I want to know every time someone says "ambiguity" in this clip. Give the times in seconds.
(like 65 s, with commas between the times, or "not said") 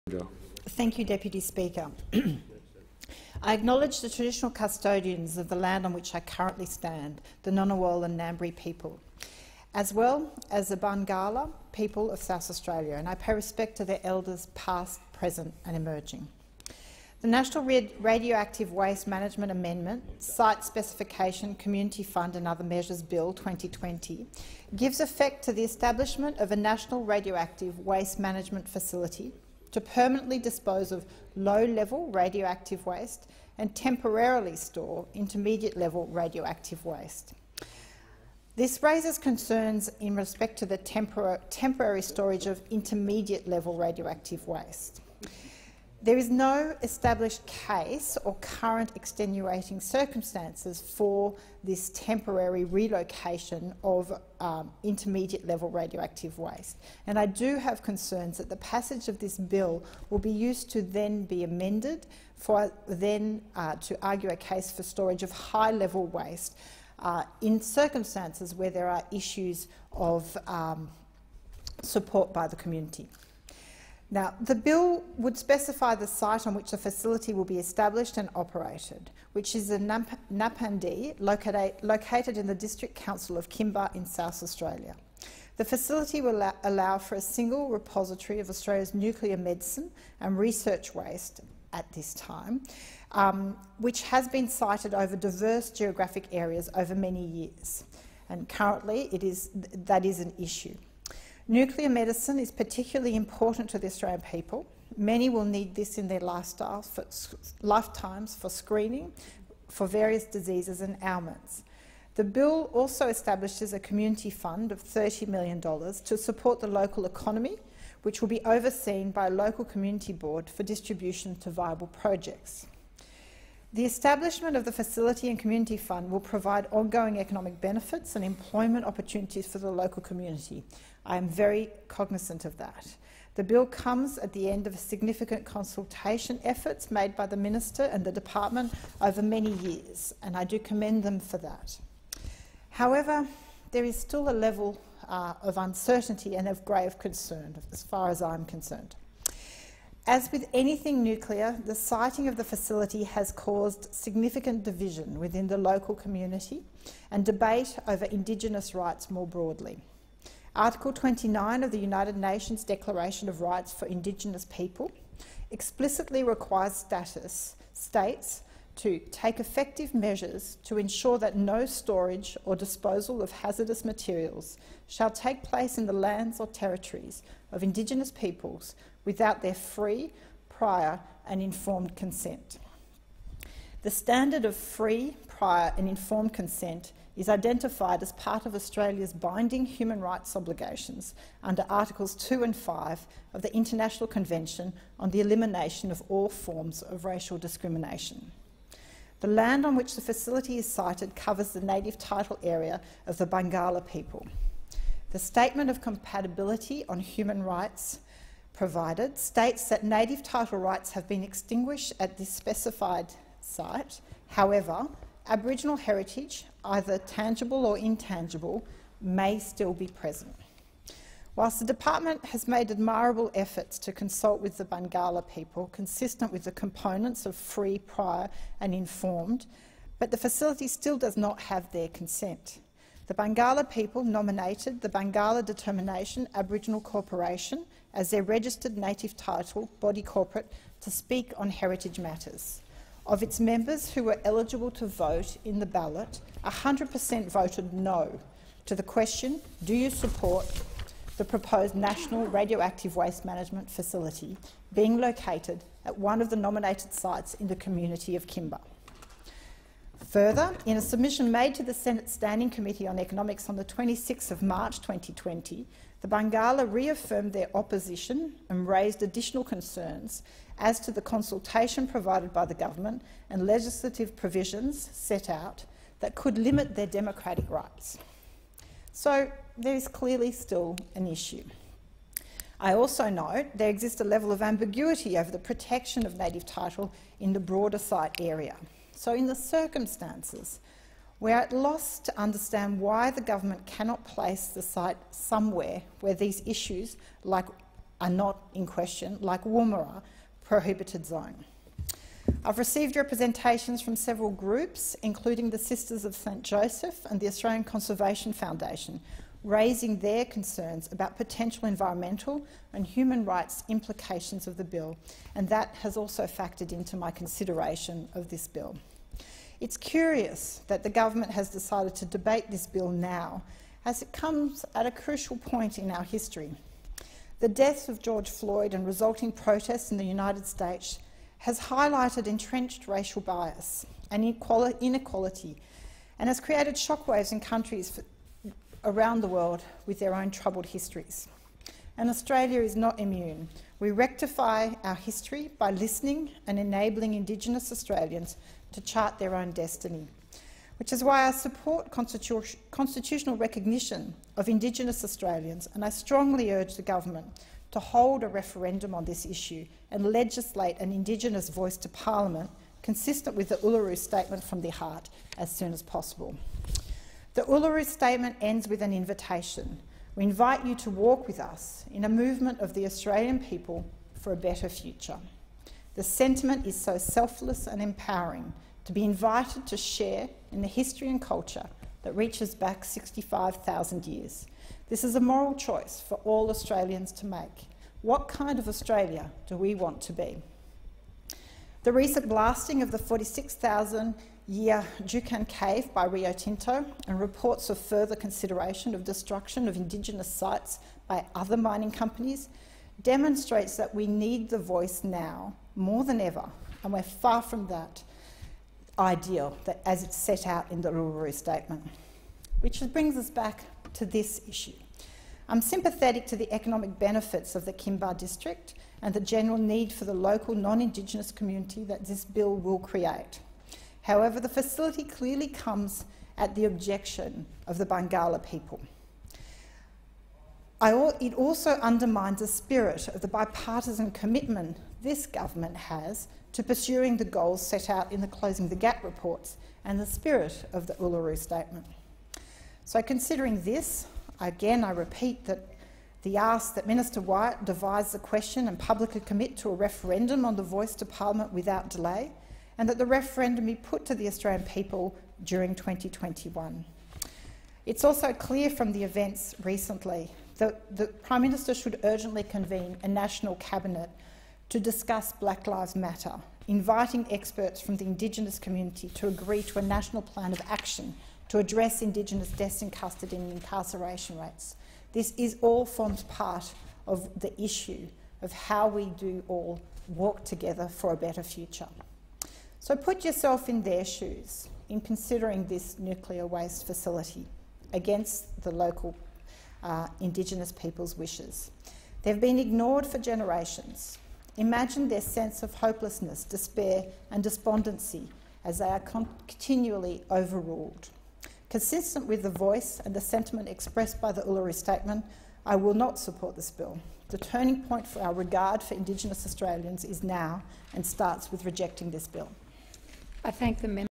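284 s.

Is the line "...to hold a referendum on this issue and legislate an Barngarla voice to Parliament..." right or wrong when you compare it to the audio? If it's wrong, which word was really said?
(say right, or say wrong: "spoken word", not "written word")
wrong: "Indigenous", not "Barngarla".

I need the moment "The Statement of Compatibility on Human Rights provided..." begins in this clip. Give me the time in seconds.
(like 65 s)
205 s.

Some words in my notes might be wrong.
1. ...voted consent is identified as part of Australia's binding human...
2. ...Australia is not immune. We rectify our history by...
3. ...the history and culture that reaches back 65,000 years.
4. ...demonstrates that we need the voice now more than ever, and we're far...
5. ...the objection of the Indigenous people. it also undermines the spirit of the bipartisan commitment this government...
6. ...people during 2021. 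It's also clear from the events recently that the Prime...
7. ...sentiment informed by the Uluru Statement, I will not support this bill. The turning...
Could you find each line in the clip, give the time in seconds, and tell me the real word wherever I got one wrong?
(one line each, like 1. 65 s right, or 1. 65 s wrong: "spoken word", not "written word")
1. 185 s wrong: "informed", not "voted"
2. 342 s right
3. 380 s right
4. 403 s right
5. 426 s wrong: "Barngarla", not "Indigenous"
6. 454 s right
7. 503 s wrong: "expressed", not "informed".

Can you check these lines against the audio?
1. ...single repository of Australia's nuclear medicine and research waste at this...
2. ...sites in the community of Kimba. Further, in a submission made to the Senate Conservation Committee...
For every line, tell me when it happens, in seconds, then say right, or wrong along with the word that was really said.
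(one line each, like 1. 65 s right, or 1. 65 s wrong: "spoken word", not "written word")
1. 87 s right
2. 256 s wrong: "Standing", not "Conservation".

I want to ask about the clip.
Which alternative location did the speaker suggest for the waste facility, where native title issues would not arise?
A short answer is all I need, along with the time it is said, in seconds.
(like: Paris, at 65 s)
Woomera, at 299 s.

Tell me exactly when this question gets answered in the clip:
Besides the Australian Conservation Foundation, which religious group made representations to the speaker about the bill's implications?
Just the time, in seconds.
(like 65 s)
305 s.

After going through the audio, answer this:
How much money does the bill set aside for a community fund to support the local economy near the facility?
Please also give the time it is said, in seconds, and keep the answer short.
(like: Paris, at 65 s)
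$30 million, at 114 s.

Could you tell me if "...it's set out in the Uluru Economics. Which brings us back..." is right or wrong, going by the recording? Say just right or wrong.
wrong.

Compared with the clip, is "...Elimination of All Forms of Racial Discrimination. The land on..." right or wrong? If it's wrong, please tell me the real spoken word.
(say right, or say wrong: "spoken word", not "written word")
right.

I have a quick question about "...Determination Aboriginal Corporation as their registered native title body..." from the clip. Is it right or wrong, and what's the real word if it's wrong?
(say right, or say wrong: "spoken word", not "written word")
right.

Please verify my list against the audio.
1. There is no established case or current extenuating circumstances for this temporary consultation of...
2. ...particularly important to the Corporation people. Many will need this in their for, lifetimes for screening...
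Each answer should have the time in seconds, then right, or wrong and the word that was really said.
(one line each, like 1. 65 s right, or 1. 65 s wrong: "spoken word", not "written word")
1. 46 s wrong: "relocation", not "consultation"
2. 102 s wrong: "Australian", not "Corporation".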